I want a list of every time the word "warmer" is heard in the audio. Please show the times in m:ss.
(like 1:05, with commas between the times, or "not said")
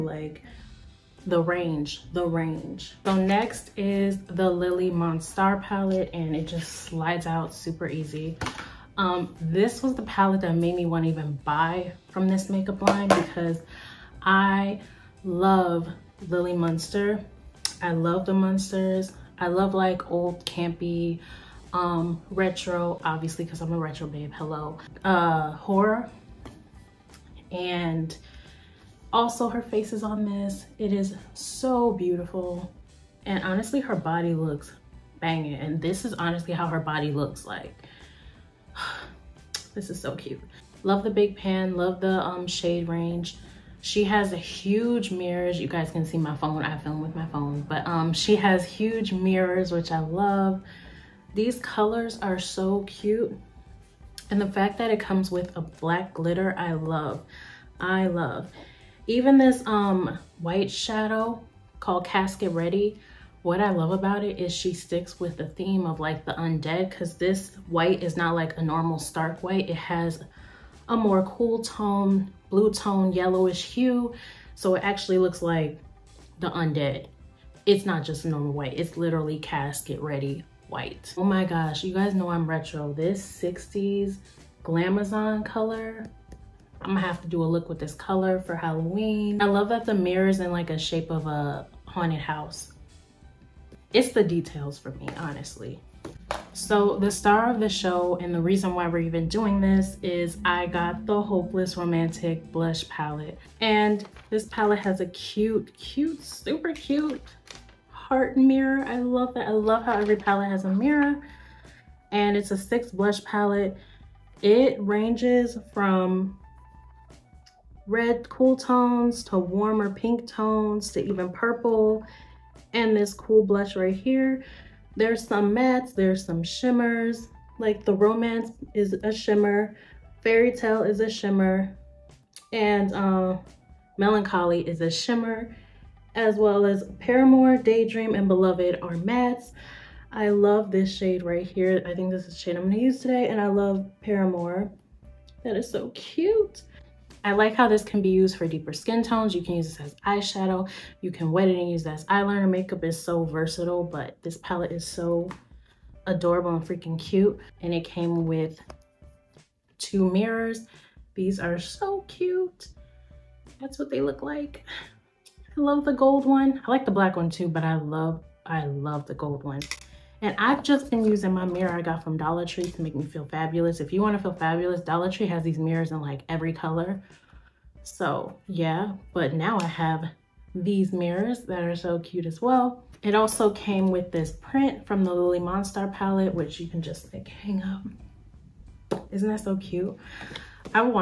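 1:59.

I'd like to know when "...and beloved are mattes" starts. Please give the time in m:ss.
2:18.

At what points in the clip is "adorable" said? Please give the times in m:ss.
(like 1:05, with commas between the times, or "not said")
2:36.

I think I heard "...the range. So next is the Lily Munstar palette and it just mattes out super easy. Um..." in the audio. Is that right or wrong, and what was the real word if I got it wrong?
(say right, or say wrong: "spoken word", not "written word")
wrong: "slides", not "mattes".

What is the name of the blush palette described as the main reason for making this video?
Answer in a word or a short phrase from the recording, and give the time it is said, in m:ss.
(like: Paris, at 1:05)
Hopeless Romantic, at 1:41.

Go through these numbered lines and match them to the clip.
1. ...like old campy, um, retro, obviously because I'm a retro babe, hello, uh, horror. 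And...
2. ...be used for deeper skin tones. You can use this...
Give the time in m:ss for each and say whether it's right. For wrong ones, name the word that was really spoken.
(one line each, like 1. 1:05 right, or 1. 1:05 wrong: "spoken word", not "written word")
1. 0:19 right
2. 2:28 right.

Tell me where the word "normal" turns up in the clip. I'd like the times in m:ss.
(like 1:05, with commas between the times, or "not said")
1:08, 1:18.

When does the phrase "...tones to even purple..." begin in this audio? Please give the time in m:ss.
2:00.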